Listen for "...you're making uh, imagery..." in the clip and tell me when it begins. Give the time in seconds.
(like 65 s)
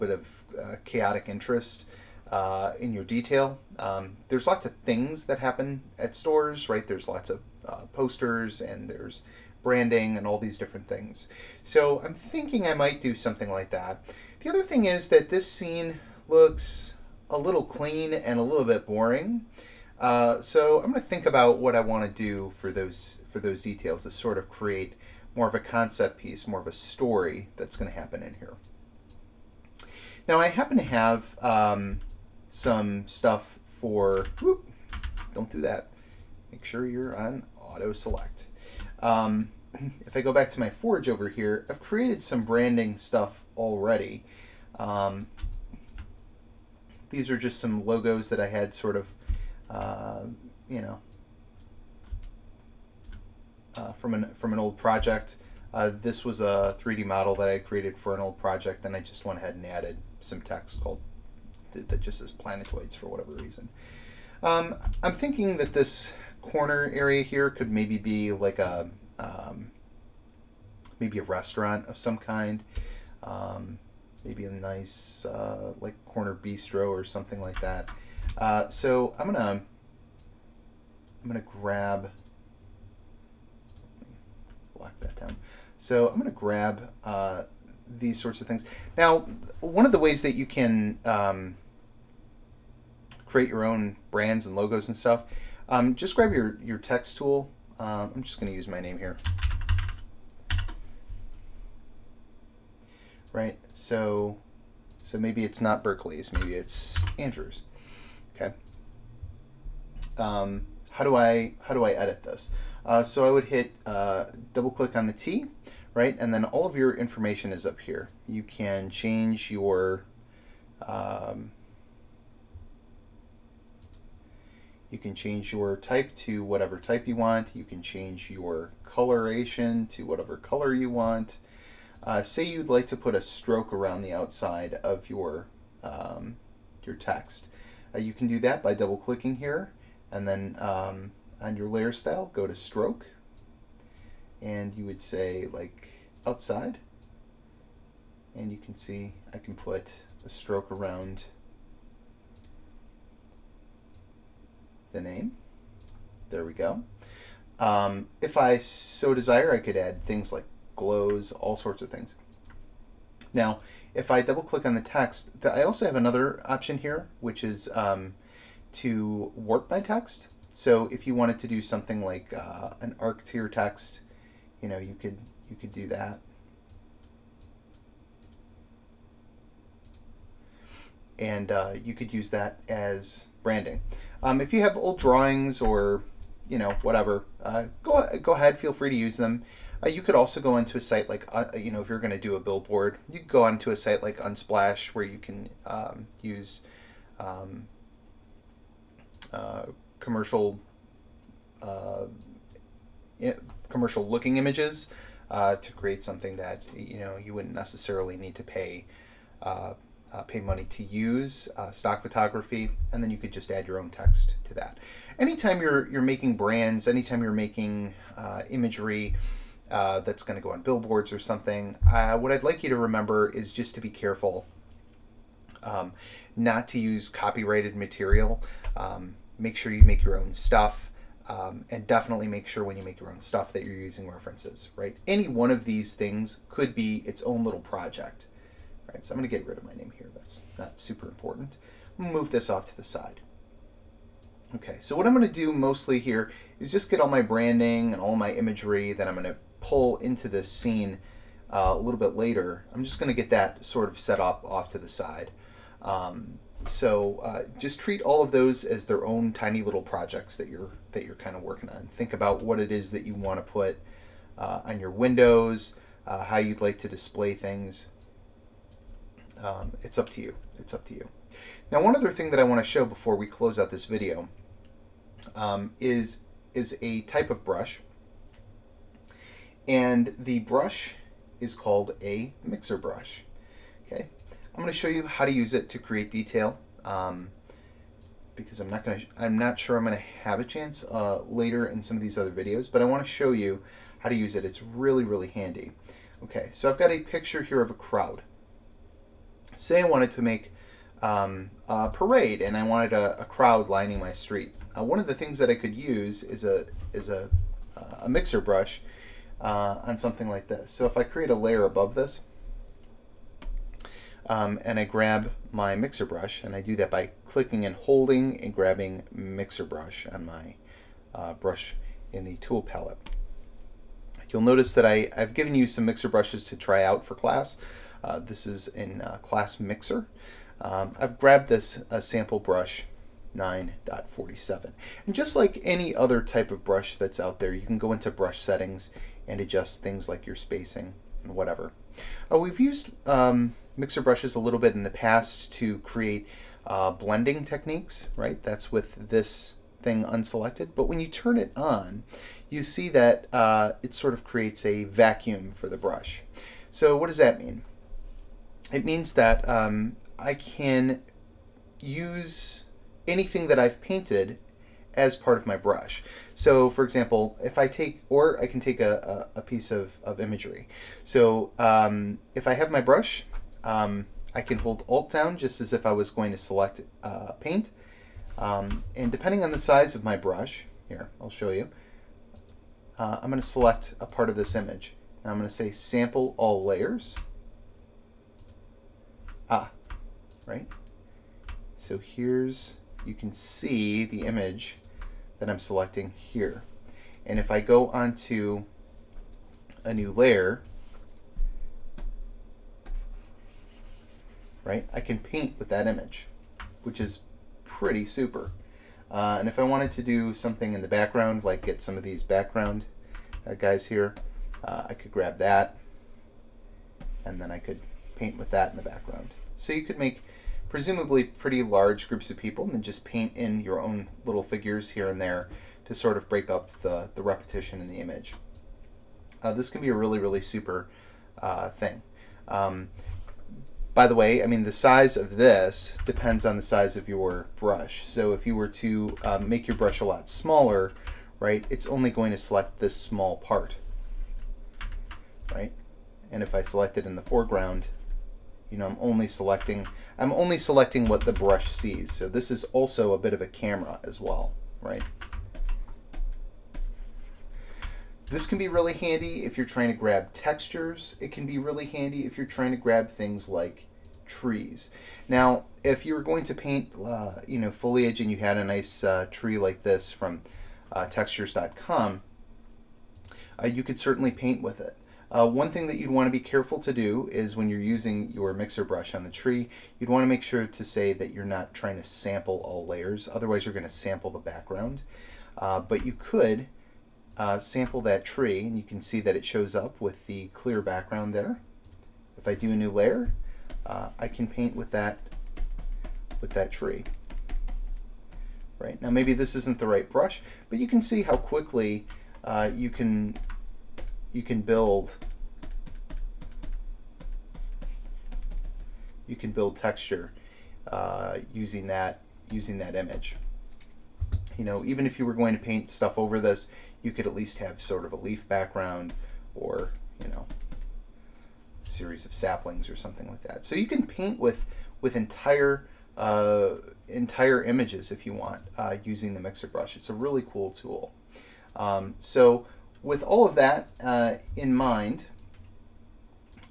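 217 s.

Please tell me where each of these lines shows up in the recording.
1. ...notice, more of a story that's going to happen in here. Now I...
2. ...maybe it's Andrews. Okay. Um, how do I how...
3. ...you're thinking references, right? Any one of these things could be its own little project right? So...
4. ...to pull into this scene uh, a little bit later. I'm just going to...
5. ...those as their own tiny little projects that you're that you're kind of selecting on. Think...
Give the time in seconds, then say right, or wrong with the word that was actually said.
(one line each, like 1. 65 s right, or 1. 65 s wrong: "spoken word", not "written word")
1. 26 s wrong: "piece", not "notice"
2. 106 s right
3. 233 s wrong: "using", not "thinking"
4. 249 s right
5. 258 s wrong: "working", not "selecting".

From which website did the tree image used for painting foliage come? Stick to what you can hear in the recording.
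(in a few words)
textures.com.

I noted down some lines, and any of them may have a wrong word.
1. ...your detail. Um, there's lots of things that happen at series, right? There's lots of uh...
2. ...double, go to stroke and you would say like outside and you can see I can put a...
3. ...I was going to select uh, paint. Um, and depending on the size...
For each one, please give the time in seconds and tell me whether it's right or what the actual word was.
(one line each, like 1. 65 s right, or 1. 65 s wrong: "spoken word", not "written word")
1. 2 s wrong: "stores", not "series"
2. 141 s wrong: "style", not "double"
3. 375 s right.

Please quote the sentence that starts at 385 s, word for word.
Now I'm going to say sample all layers.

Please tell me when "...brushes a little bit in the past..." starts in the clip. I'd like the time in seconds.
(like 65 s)
344 s.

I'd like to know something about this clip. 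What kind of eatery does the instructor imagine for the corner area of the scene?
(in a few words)
Corner bistro.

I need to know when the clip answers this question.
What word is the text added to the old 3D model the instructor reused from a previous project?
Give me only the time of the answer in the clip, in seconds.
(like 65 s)
62 s.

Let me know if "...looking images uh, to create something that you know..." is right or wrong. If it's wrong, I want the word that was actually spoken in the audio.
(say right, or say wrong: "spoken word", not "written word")
right.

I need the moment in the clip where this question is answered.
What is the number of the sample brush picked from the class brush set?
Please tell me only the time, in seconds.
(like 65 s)
333 s.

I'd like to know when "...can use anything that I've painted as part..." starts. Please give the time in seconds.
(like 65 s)
360 s.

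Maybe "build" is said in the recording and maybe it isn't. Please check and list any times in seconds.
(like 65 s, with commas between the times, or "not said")
504 s, 509 s.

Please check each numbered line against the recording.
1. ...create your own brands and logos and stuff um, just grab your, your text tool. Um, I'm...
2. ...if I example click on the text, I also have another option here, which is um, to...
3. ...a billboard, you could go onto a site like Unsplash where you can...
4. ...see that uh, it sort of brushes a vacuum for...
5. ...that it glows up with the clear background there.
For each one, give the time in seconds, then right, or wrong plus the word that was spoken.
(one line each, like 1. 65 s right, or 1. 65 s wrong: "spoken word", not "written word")
1. 93 s right
2. 163 s wrong: "double", not "example"
3. 192 s right
4. 352 s wrong: "creates", not "brushes"
5. 489 s wrong: "shows", not "glows".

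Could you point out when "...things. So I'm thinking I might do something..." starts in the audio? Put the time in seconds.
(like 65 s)
10 s.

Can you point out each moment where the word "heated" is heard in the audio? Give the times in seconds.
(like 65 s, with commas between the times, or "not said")
not said.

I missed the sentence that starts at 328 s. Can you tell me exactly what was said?
Uh, this is in uh, class mixer.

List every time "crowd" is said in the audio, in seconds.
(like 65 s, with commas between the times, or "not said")
297 s, 303 s.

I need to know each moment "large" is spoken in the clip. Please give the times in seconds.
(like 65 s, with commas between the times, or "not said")
421 s.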